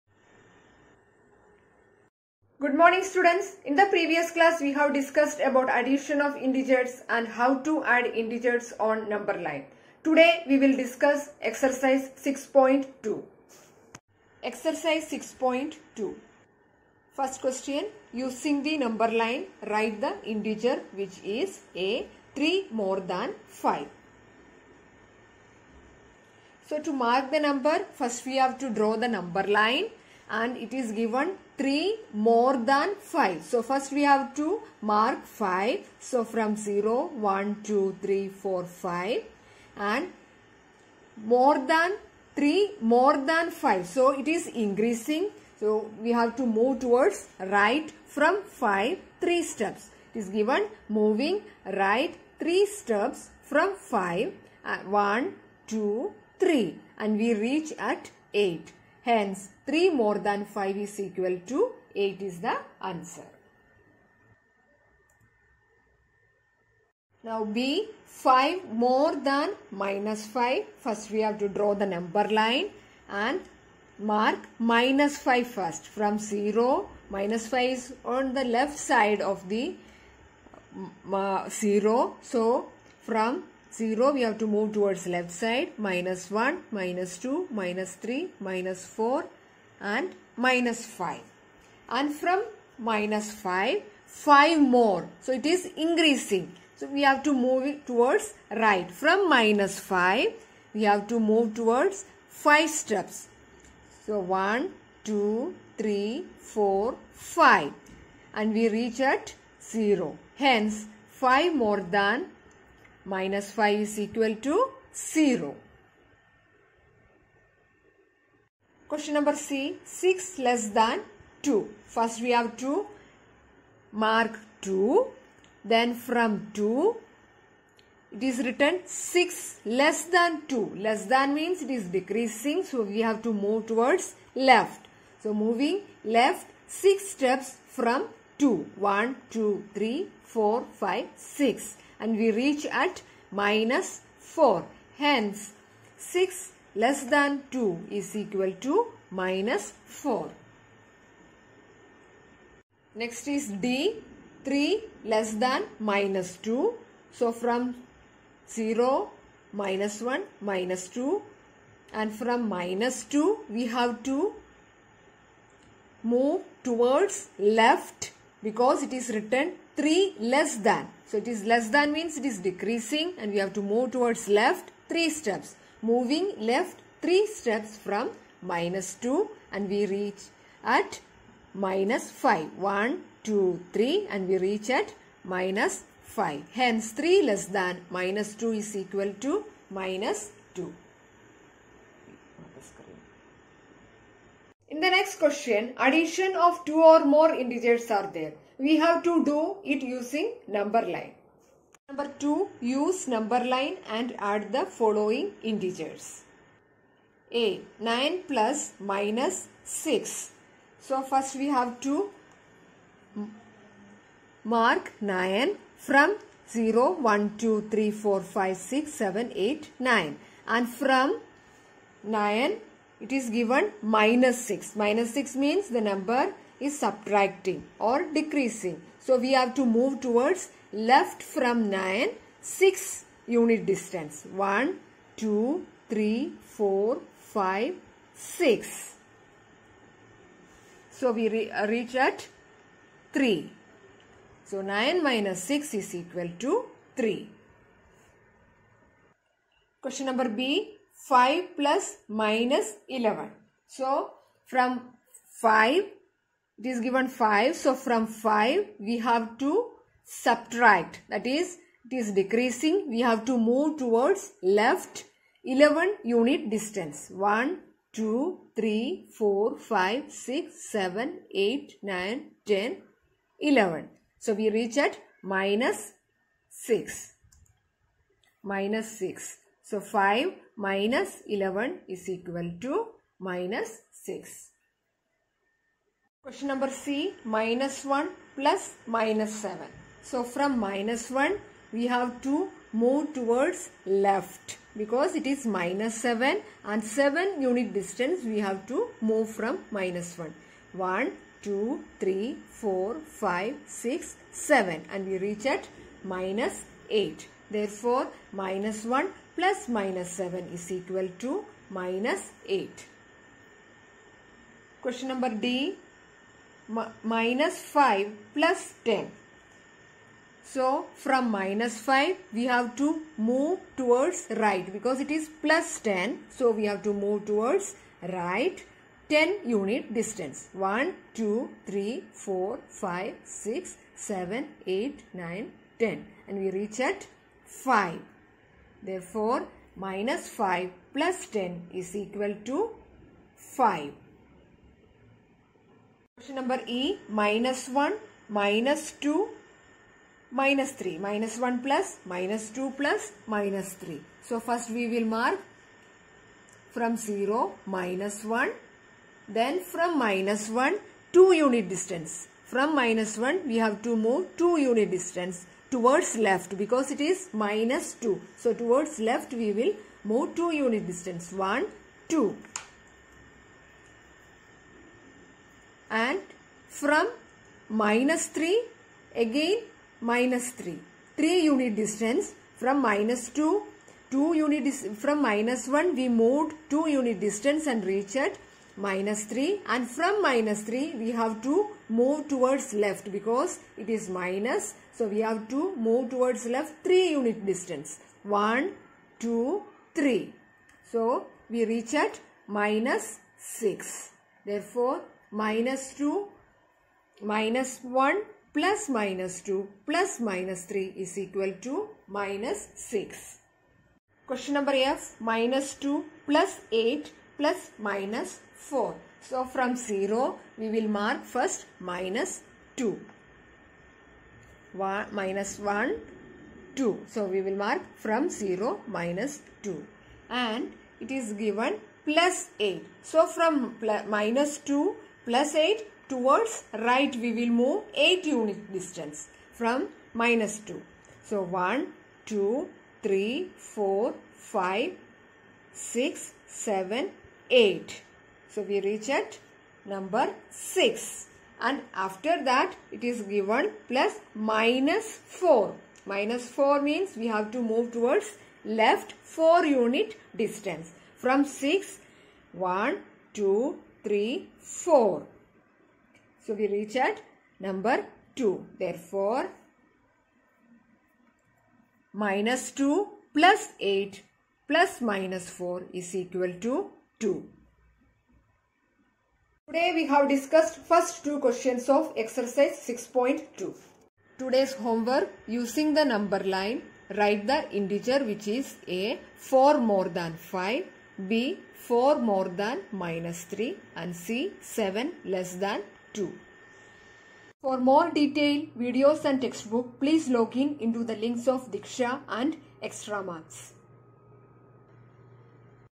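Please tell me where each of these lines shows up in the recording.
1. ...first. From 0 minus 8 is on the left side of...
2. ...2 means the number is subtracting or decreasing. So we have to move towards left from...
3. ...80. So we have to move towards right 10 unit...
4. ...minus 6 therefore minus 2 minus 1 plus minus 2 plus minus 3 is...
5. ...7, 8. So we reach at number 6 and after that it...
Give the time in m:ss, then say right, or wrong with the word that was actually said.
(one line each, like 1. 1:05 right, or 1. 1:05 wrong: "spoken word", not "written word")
1. 1:15 wrong: "5", not "8"
2. 3:45 wrong: "6", not "2"
3. 5:25 wrong: "10", not "80"
4. 6:42 right
5. 7:26 right.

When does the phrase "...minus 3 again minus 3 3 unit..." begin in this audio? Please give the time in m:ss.
6:17.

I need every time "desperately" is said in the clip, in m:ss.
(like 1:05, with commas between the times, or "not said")
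not said.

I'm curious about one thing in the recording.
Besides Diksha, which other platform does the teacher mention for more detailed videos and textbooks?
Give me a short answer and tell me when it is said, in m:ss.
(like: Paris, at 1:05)
Extra Marks, at 8:22.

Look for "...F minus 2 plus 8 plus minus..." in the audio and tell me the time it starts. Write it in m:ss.
6:54.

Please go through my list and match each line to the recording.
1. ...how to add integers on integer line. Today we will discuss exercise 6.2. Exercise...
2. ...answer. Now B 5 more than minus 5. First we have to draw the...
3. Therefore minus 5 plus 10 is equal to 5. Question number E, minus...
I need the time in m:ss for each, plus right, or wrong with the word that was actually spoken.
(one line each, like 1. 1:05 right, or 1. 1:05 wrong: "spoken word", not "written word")
1. 0:07 wrong: "number", not "integer"
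2. 1:02 right
3. 5:38 right.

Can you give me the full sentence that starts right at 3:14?
In the next question, addition of two or more integers are there.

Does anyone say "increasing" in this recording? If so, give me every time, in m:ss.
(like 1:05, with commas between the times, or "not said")
0:44, 1:35.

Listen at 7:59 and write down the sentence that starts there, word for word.
Today we have discussed first two questions of exercise 6.2.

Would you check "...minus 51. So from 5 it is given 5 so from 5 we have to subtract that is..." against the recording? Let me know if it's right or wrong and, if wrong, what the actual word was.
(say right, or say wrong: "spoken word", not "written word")
wrong: "11", not "51".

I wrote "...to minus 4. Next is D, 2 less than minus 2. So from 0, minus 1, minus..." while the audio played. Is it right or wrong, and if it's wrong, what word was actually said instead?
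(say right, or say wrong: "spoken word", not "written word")
wrong: "3", not "2".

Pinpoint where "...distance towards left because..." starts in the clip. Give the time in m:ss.
6:04.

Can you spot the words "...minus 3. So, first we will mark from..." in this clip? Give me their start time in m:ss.
5:53.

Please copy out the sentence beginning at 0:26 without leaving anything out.
So to mark the number first we have to draw the number line and it is given 3 more than 5.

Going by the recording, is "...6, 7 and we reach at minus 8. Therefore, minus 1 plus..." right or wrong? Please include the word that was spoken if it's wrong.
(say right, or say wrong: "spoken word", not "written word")
right.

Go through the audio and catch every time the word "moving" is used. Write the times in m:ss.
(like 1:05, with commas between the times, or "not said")
0:50, 2:15, 2:55.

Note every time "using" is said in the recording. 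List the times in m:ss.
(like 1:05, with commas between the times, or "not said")
0:18, 3:19, 8:05.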